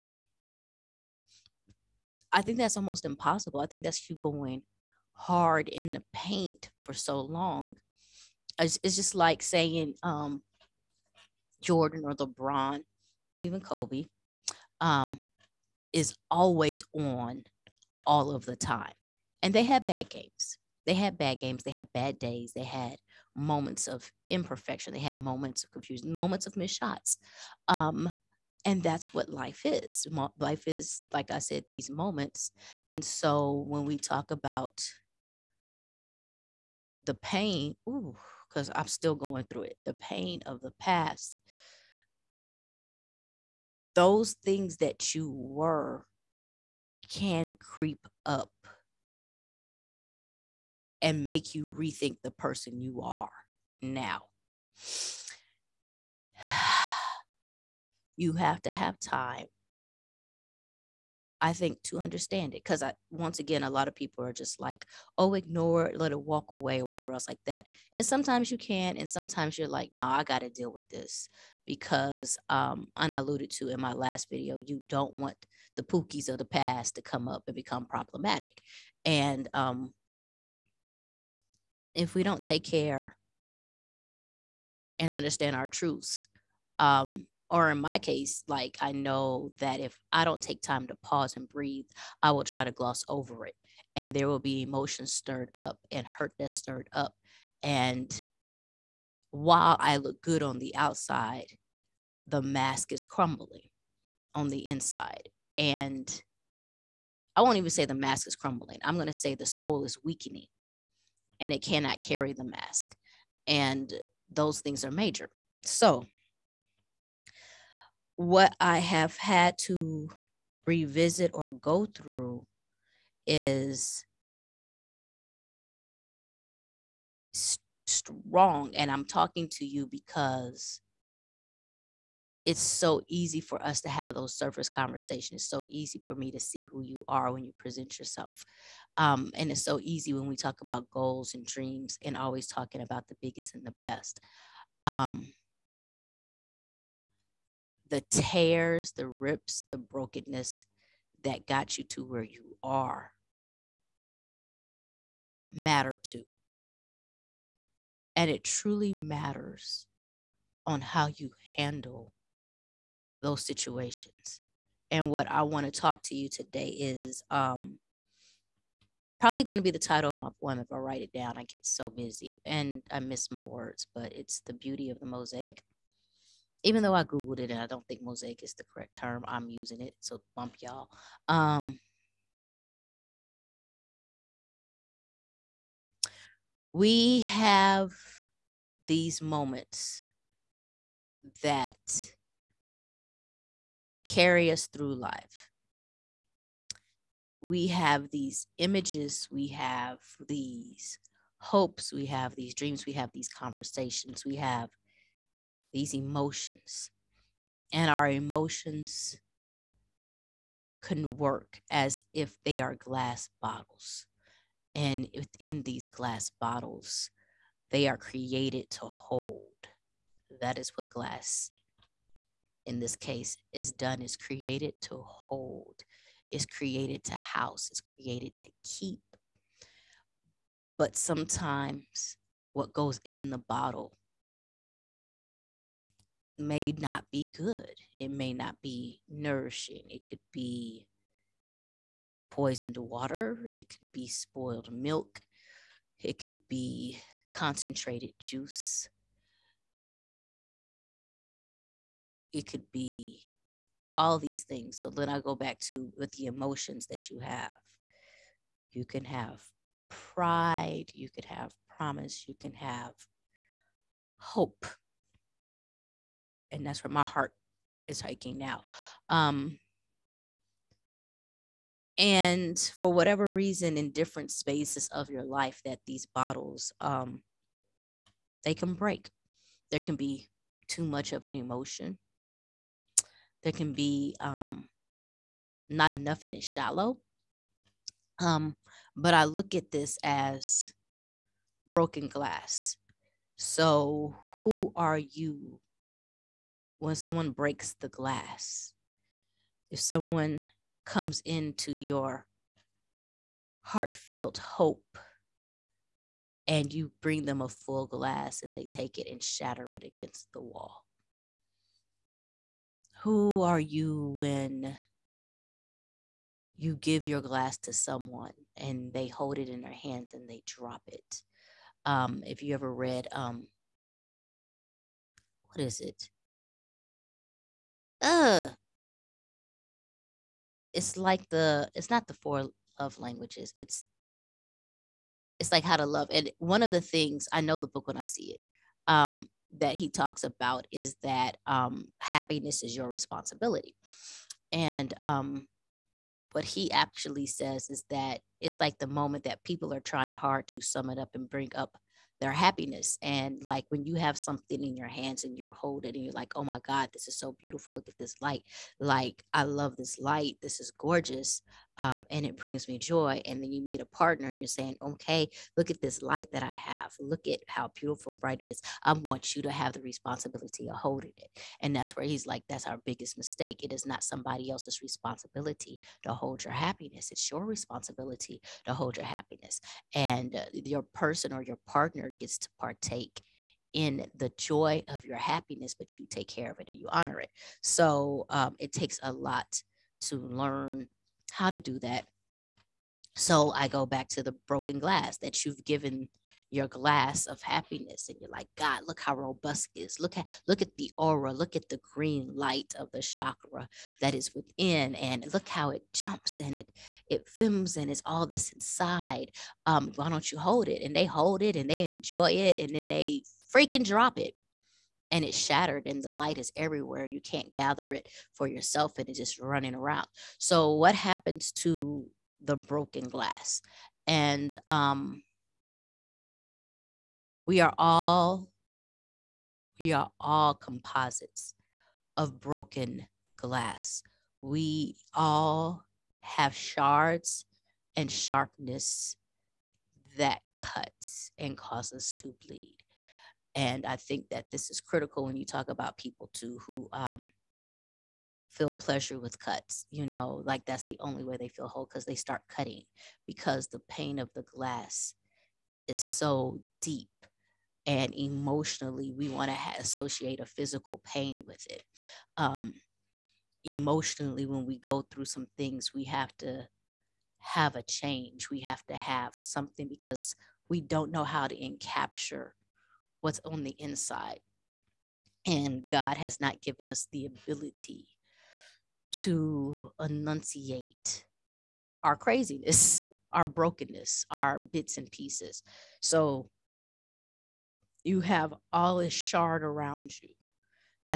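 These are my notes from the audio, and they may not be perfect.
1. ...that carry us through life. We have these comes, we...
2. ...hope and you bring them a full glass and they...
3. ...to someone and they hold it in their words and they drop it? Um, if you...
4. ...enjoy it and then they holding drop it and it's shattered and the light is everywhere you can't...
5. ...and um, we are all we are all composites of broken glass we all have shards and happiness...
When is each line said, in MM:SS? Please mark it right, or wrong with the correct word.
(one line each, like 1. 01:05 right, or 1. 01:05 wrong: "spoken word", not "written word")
1. 03:11 wrong: "images", not "comes"
2. 05:04 right
3. 05:17 wrong: "hands", not "words"
4. 06:51 wrong: "freaking", not "holding"
5. 07:04 wrong: "sharpness", not "happiness".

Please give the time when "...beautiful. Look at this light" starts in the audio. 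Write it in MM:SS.
05:57.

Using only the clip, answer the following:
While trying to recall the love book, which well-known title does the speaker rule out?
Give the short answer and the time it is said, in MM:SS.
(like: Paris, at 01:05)
the four love languages, at 05:32.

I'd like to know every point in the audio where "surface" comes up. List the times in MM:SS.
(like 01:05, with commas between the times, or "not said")
02:14.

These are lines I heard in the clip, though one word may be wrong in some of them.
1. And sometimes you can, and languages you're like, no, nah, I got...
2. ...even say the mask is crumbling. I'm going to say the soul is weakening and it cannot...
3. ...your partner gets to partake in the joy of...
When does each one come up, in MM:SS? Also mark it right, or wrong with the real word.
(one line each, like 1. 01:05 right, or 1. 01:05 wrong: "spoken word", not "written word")
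1. 01:07 wrong: "sometimes", not "languages"
2. 01:47 right
3. 06:21 right.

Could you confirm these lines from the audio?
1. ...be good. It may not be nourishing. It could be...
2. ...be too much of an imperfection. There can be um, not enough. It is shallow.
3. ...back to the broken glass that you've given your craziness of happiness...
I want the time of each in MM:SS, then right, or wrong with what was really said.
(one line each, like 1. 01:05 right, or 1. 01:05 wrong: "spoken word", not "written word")
1. 03:57 right
2. 04:39 wrong: "emotion", not "imperfection"
3. 06:33 wrong: "glass", not "craziness".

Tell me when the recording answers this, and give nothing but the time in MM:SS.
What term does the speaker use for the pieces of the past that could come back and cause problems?
01:15.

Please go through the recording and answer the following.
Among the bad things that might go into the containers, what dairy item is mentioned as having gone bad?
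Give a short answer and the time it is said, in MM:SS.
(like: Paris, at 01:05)
spoiled milk, at 04:04.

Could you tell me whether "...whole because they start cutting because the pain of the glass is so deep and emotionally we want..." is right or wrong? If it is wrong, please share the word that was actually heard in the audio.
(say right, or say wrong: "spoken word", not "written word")
right.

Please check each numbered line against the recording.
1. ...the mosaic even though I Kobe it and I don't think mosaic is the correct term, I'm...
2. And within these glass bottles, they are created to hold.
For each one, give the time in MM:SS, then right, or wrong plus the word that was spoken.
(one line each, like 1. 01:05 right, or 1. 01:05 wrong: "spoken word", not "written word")
1. 02:54 wrong: "Googled", not "Kobe"
2. 03:34 right.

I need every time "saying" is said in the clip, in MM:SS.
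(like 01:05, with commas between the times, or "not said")
00:09, 06:04.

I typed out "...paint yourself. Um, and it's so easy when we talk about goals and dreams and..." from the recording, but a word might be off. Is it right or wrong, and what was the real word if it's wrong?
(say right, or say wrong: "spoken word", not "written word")
wrong: "present", not "paint".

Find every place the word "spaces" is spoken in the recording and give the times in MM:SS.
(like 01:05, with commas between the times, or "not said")
04:34.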